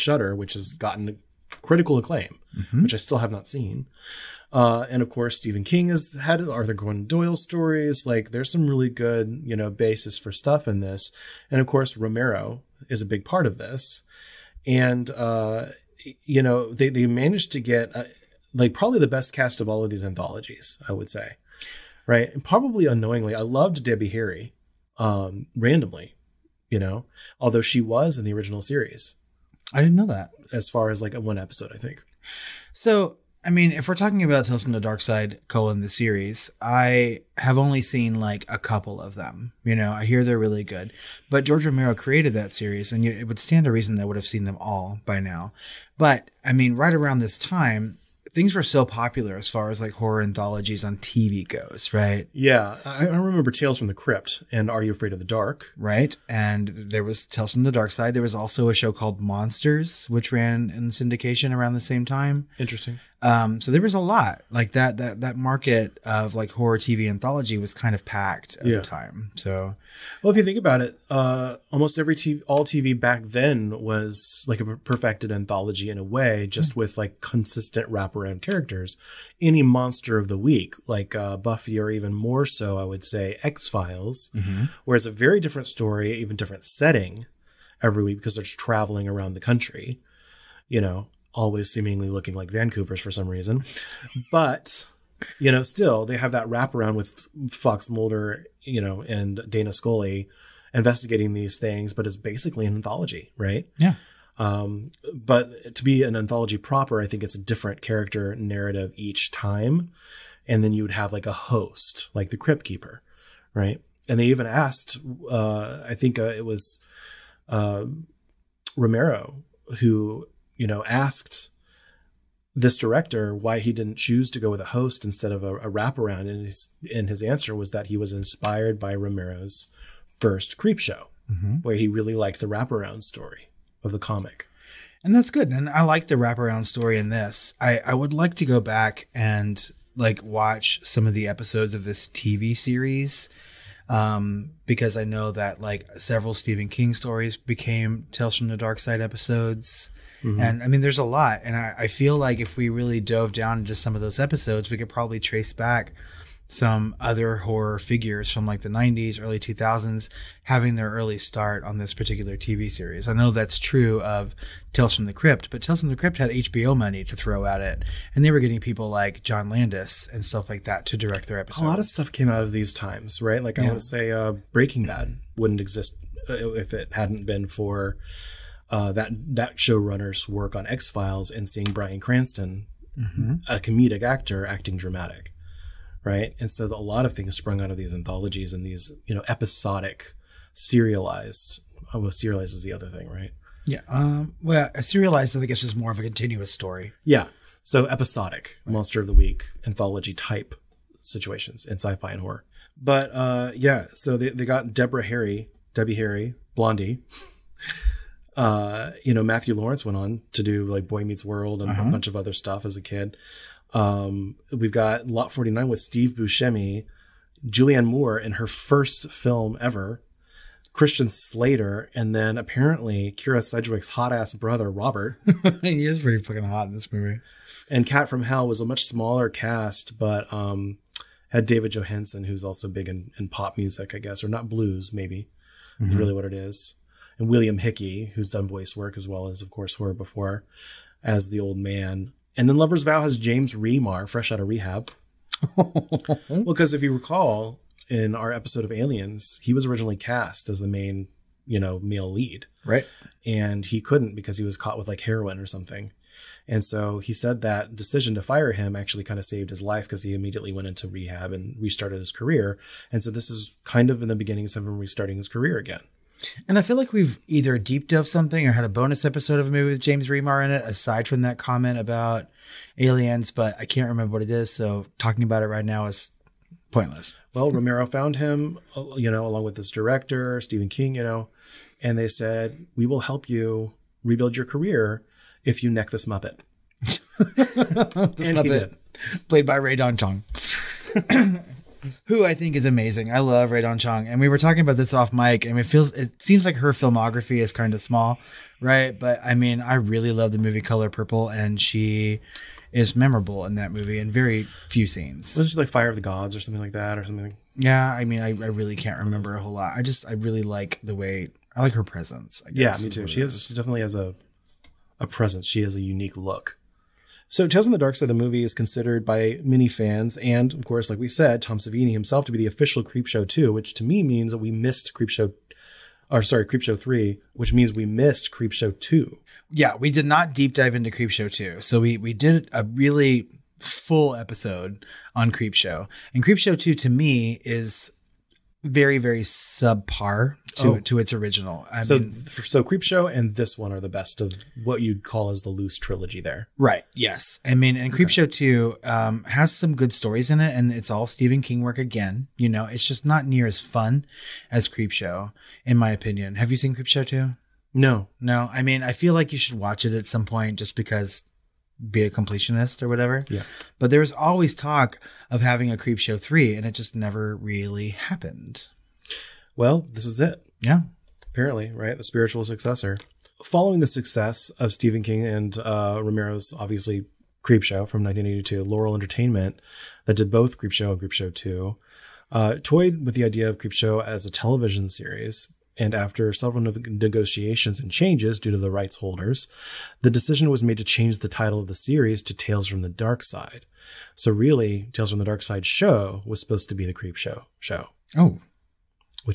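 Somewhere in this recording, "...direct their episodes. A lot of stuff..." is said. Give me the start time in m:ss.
2:50.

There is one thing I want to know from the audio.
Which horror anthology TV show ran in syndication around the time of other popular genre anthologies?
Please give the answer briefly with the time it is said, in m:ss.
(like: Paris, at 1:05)
Monsters, at 0:59.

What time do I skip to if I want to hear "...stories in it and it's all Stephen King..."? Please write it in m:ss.
5:49.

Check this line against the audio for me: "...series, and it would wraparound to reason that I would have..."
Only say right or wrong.
wrong.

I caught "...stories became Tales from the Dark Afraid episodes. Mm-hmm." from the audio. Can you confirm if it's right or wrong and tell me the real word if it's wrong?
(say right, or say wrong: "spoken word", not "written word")
wrong: "Side", not "Afraid".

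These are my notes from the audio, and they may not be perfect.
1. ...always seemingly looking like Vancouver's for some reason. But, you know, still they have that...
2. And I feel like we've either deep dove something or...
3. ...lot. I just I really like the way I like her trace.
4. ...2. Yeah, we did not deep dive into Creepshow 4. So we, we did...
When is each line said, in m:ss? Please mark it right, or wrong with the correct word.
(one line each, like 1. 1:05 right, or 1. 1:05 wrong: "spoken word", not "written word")
1. 1:31 right
2. 4:26 right
3. 5:09 wrong: "presence", not "trace"
4. 5:28 wrong: "2", not "4".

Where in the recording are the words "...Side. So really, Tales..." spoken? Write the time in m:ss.
6:33.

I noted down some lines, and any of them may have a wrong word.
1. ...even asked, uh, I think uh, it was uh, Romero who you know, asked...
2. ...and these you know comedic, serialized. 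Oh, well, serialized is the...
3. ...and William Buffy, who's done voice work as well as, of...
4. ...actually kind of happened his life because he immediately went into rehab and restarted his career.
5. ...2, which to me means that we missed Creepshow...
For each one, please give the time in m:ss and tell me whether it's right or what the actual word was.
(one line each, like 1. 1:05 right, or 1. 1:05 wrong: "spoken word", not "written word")
1. 1:54 right
2. 3:08 wrong: "episodic", not "comedic"
3. 3:57 wrong: "Hickey", not "Buffy"
4. 4:18 wrong: "saved", not "happened"
5. 5:23 right.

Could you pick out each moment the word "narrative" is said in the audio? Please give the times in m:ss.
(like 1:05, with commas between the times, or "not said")
1:48.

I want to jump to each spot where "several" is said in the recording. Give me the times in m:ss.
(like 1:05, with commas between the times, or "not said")
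2:25, 6:26.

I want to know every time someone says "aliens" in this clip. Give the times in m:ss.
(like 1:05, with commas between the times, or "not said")
4:08, 4:32.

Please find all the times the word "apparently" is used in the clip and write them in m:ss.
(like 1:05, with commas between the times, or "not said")
3:42, 6:11.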